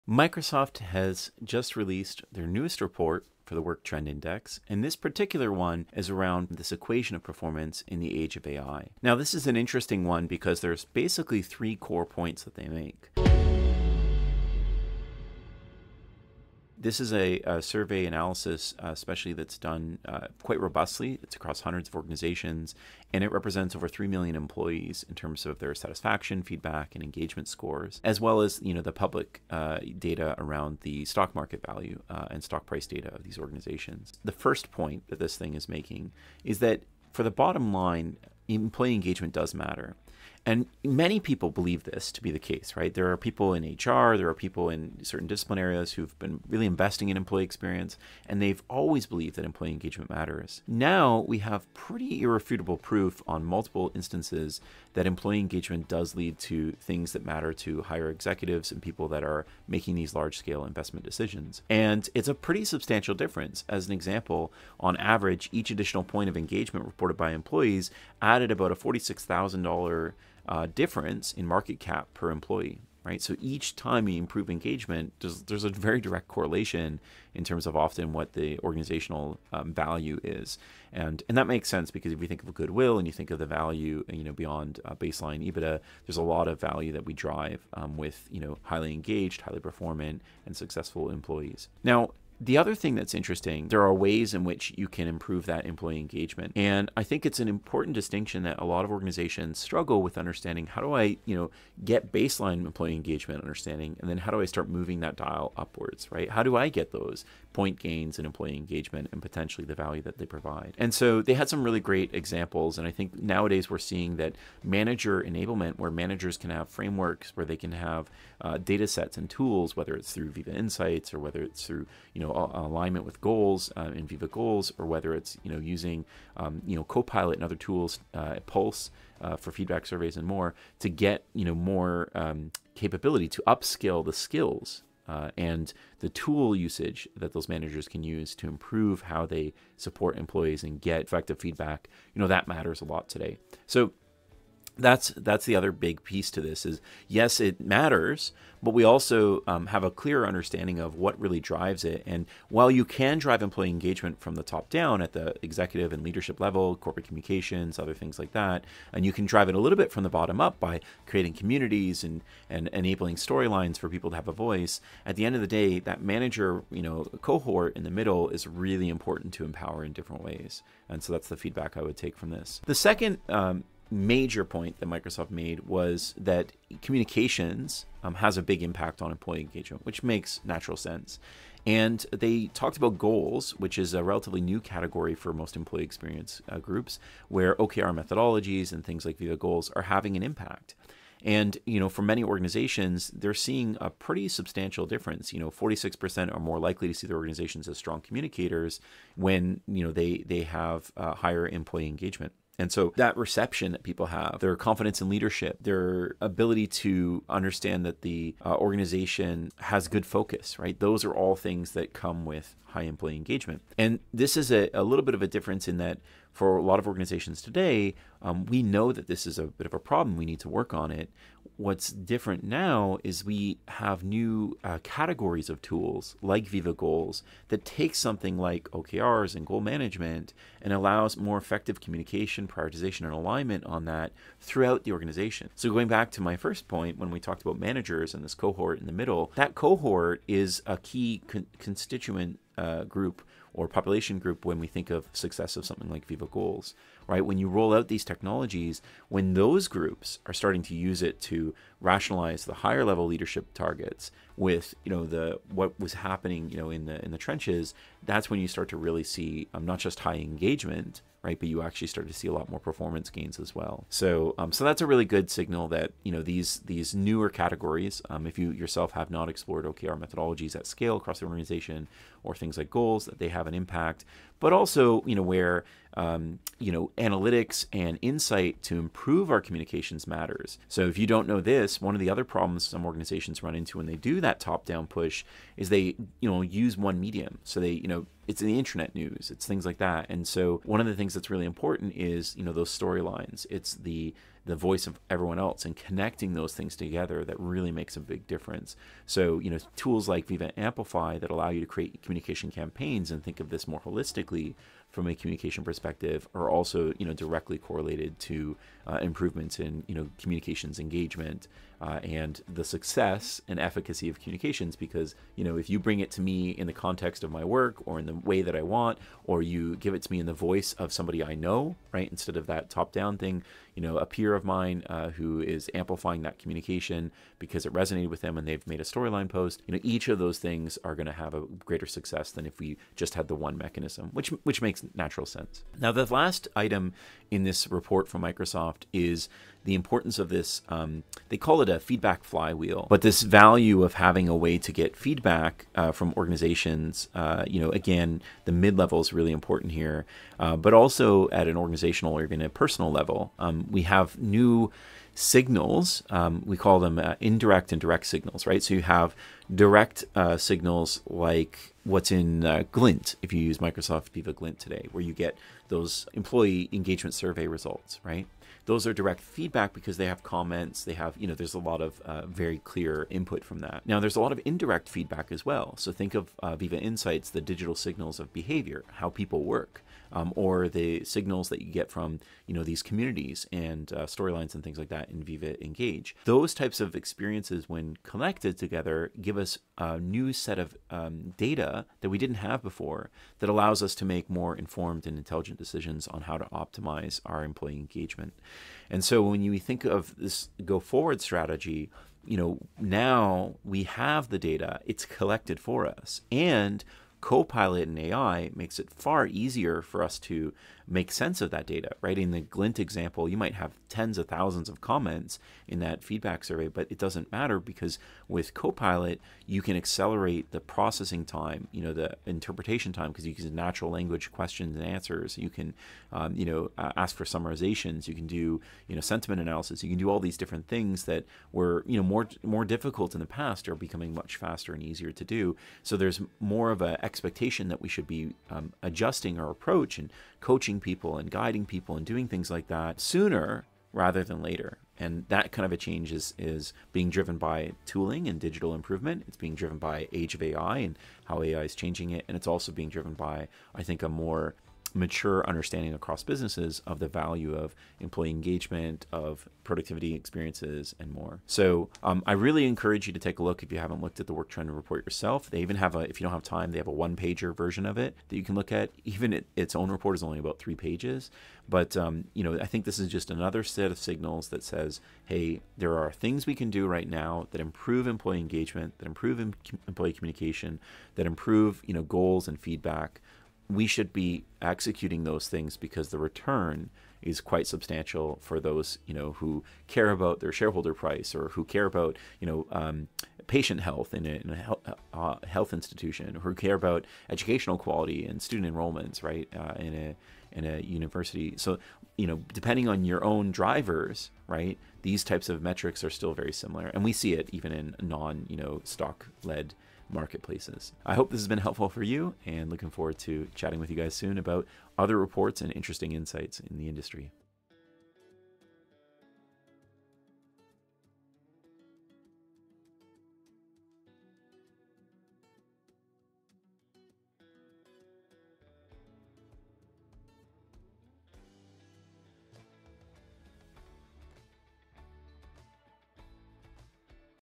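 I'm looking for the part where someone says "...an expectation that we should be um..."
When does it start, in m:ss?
7:16.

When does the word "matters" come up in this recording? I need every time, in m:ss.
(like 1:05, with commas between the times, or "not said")
0:39, 0:50, 0:57, 2:22, 2:27, 4:40, 6:57.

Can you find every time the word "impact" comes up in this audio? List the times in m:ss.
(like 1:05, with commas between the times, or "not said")
2:58, 3:10, 4:33.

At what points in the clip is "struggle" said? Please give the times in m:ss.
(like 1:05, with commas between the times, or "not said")
1:39.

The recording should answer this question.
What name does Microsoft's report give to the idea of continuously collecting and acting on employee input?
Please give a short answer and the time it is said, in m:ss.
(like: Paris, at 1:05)
feedback flywheel, at 5:41.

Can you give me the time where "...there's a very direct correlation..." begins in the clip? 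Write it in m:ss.
1:15.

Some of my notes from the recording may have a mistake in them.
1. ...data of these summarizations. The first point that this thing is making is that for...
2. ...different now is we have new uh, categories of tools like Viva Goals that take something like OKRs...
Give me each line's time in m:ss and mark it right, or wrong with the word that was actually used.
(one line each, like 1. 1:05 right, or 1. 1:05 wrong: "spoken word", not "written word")
1. 0:32 wrong: "organizations", not "summarizations"
2. 3:41 right.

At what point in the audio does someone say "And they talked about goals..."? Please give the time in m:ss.
3:01.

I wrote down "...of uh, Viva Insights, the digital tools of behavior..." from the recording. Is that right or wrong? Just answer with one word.
wrong.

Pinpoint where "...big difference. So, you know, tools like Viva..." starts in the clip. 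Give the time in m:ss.
4:57.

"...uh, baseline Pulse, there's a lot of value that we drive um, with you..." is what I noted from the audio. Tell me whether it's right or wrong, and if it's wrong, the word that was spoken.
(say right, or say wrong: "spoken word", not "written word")
wrong: "EBITDA", not "Pulse".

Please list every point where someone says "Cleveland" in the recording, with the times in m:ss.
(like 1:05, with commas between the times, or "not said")
not said.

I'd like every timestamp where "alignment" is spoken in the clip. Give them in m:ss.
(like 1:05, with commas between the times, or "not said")
2:02, 3:53.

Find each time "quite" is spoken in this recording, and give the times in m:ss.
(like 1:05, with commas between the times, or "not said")
0:20, 8:07.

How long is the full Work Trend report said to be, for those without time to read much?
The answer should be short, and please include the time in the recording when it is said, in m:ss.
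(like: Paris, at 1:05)
3 pages, at 7:50.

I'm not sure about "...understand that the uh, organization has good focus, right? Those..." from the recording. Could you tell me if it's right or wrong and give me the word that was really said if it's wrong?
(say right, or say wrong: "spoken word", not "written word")
right.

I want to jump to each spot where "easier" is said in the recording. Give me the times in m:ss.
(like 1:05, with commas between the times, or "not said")
6:49, 7:14.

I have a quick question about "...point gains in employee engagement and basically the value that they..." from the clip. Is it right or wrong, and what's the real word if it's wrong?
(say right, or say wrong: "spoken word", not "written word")
wrong: "potentially", not "basically".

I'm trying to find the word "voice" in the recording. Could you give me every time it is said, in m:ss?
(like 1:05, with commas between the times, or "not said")
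2:44, 4:54, 5:20.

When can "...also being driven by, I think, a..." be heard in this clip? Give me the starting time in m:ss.
7:32.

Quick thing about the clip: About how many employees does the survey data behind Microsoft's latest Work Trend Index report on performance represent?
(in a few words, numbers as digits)
3 million.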